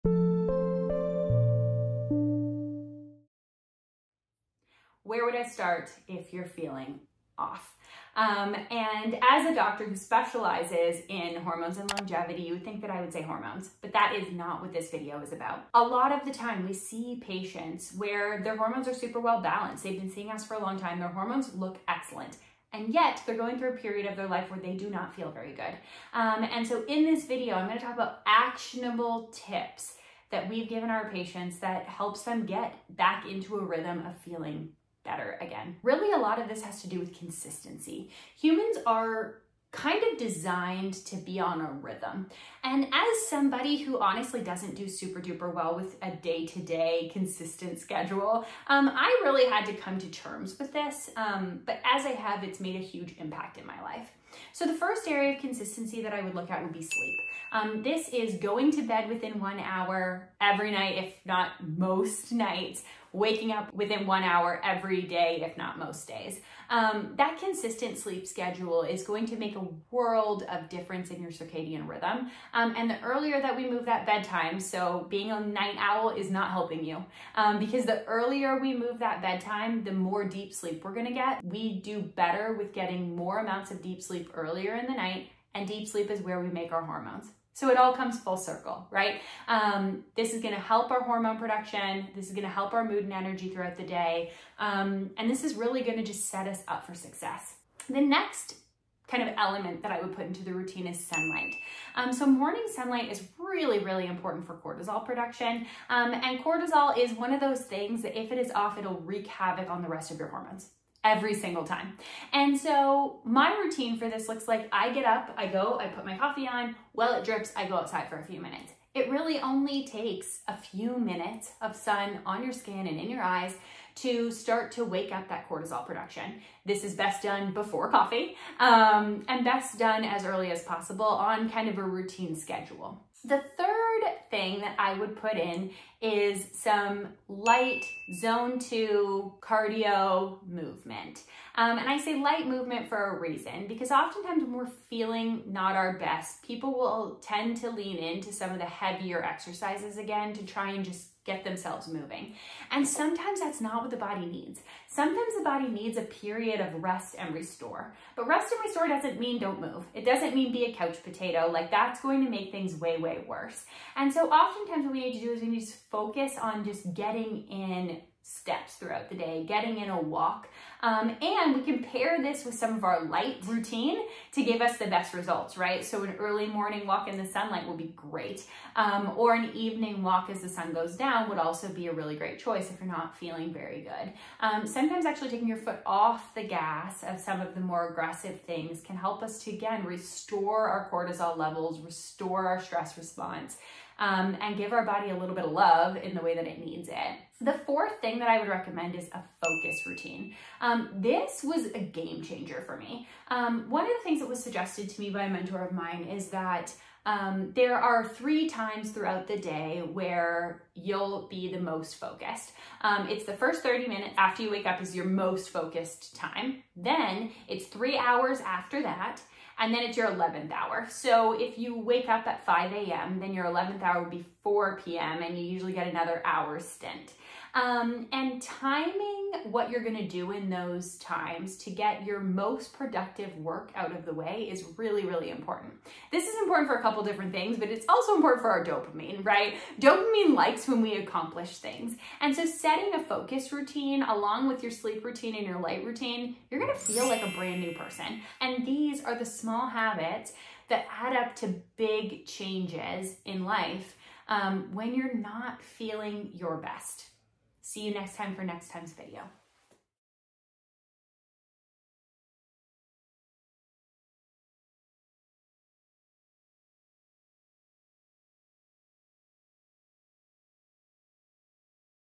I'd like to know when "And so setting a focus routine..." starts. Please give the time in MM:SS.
04:02.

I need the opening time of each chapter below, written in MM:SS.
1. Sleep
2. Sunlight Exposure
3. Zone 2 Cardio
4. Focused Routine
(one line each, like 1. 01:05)
1. 00:54
2. 01:37
3. 02:13
4. 03:17.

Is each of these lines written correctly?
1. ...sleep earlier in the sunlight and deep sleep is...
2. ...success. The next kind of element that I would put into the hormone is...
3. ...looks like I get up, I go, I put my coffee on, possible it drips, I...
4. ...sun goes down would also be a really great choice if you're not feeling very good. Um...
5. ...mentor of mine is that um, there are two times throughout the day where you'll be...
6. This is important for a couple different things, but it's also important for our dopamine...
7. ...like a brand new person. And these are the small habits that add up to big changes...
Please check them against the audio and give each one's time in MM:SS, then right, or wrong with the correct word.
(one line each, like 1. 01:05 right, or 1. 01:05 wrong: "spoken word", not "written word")
1. 01:24 wrong: "night", not "sunlight"
2. 01:36 wrong: "routine", not "hormone"
3. 01:54 wrong: "while", not "possible"
4. 03:00 right
5. 03:25 wrong: "three", not "two"
6. 03:56 right
7. 04:07 right.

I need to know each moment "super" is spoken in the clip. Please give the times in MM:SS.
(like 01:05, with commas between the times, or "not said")
00:18, 00:44.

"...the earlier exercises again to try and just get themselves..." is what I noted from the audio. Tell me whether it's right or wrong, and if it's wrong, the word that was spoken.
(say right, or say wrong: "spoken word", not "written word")
wrong: "heavier", not "earlier".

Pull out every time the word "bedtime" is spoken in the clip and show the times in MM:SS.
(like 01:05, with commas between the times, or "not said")
01:14, 01:19.